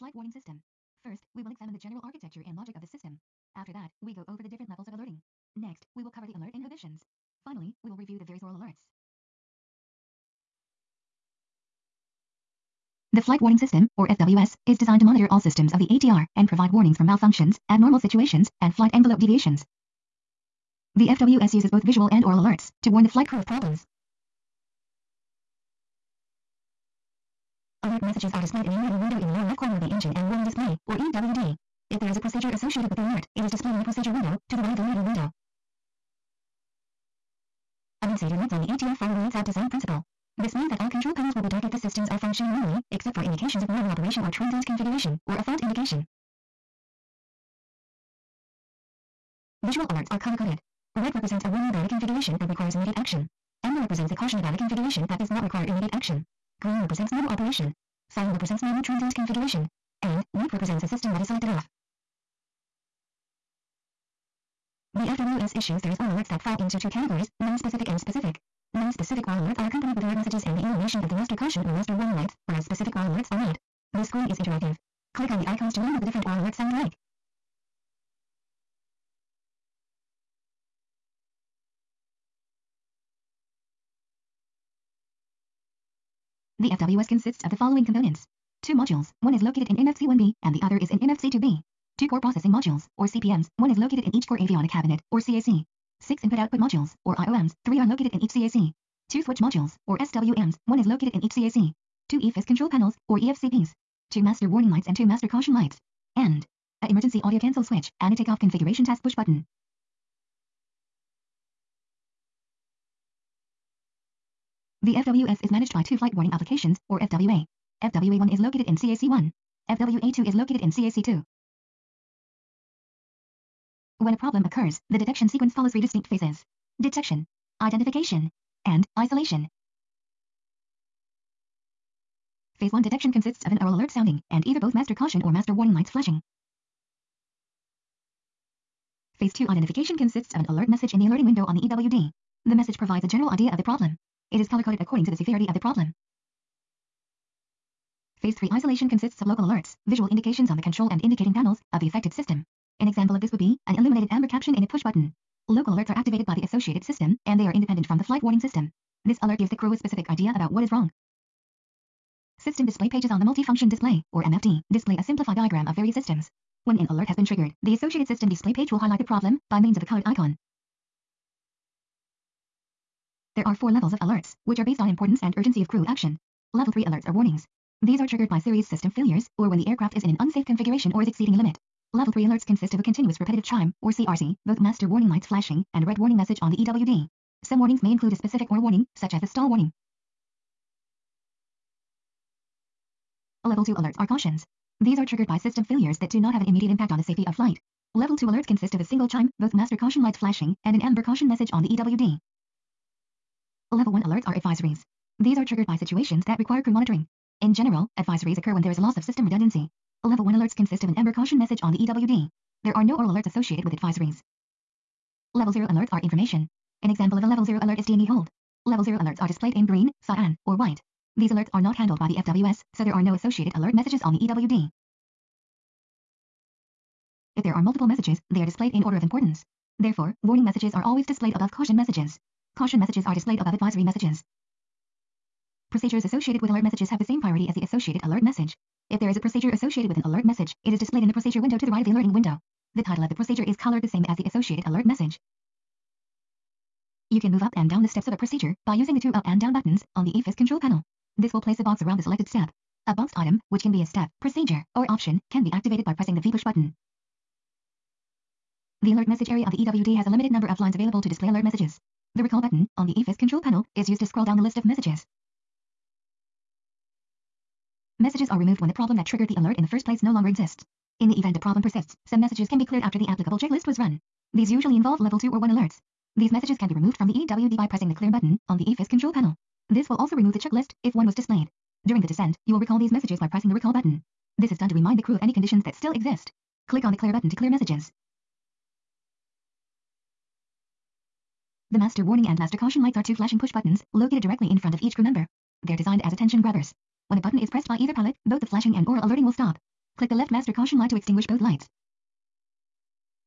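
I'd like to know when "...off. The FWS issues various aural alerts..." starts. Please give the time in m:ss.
1:01.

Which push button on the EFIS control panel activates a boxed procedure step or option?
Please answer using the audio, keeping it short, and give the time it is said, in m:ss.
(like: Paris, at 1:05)
V push button, at 4:16.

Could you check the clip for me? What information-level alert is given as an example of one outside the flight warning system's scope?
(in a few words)
DME hold.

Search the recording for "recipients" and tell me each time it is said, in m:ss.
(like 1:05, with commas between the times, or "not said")
not said.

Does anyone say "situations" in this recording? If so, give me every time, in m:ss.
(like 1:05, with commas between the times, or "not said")
0:17, 3:25.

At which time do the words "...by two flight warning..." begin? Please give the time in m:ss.
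1:55.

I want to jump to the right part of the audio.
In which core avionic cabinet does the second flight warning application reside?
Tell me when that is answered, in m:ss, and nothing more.
2:00.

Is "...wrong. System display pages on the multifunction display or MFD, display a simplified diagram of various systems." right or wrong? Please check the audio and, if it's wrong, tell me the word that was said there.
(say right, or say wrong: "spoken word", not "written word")
right.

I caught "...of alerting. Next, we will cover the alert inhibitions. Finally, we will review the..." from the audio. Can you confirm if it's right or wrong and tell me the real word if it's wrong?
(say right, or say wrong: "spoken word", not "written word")
right.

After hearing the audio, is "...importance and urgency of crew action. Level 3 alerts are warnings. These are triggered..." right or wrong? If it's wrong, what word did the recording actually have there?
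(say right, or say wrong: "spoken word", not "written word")
right.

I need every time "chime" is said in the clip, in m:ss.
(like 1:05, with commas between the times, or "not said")
3:03, 3:19.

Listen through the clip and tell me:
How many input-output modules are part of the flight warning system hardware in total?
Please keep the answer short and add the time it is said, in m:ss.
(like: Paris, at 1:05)
6, at 1:36.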